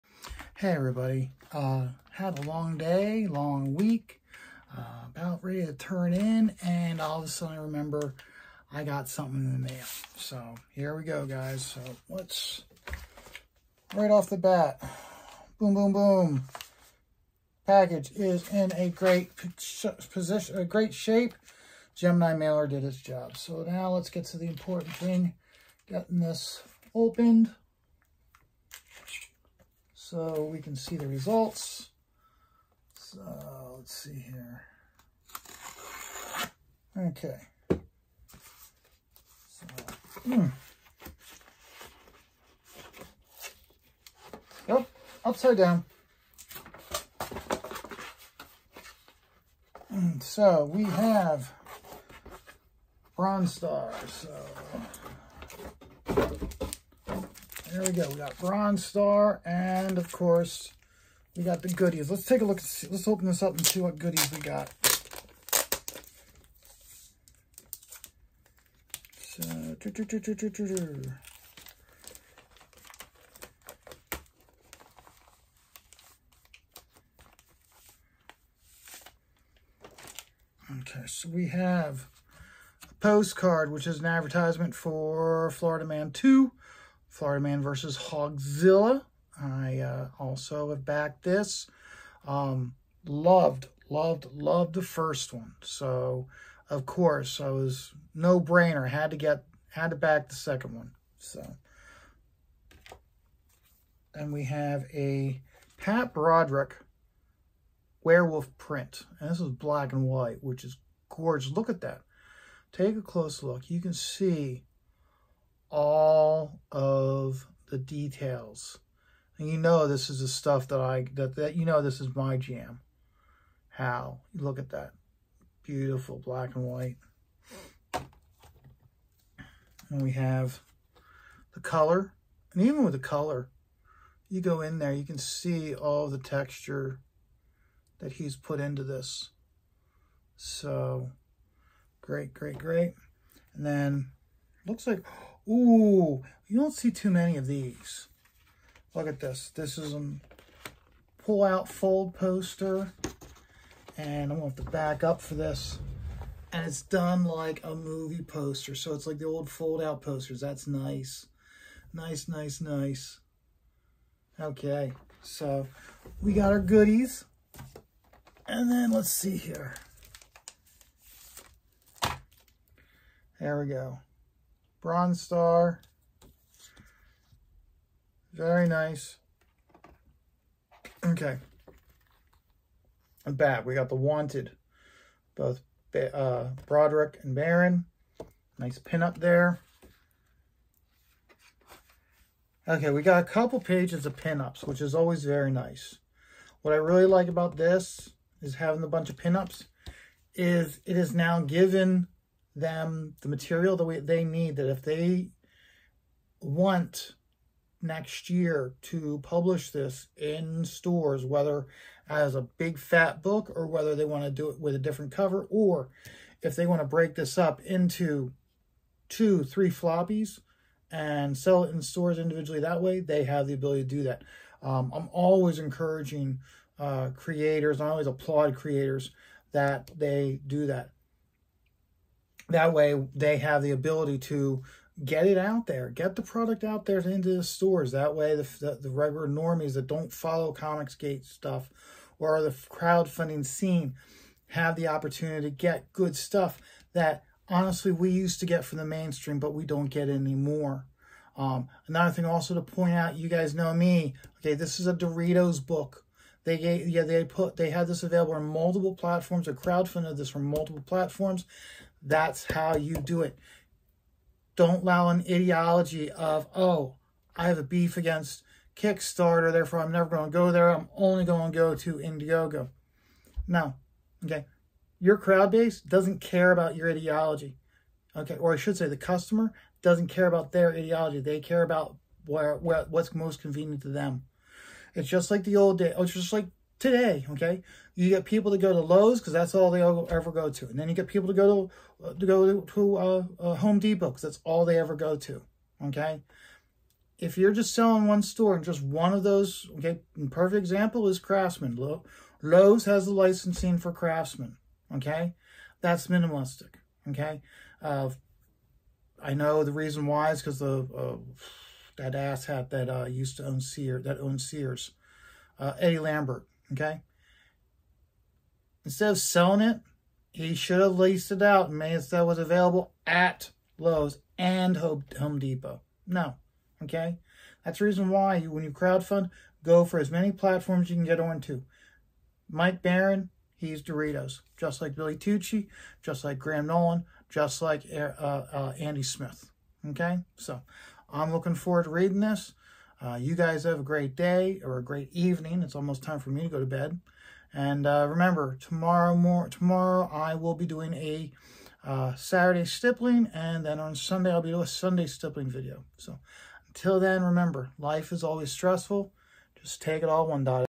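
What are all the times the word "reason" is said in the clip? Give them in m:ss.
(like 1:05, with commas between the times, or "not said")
5:09, 5:27.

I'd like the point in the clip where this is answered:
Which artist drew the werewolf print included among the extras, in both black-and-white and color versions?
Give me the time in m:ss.
1:45.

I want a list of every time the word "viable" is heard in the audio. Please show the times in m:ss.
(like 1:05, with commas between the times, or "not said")
not said.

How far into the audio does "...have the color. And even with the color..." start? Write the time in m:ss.
2:10.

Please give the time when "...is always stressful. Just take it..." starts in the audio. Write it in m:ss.
5:58.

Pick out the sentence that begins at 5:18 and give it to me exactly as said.
Instead of selling it, he should have leased it out and made it so it was available at Lowe's and Home Depot.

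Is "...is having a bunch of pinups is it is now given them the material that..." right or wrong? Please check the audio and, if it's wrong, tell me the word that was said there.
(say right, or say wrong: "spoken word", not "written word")
right.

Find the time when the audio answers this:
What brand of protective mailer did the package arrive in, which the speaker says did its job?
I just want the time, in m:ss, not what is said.
0:21.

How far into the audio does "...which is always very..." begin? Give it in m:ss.
3:14.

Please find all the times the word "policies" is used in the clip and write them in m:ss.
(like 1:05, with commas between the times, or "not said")
not said.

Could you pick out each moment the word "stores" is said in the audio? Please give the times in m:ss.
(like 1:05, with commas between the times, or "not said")
3:30, 3:41, 3:57, 4:58.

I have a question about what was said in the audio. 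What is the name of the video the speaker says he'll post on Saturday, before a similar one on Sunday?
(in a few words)
Saturday stippling.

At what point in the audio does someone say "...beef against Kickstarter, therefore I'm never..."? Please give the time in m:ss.
4:27.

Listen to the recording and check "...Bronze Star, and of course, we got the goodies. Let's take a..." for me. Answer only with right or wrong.
right.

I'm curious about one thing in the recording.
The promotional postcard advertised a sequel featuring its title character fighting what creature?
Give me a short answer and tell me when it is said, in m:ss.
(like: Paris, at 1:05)
Hogzilla, at 1:27.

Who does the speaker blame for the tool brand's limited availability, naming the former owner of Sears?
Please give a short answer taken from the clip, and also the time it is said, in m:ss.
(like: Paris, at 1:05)
Eddie Lambert, at 5:15.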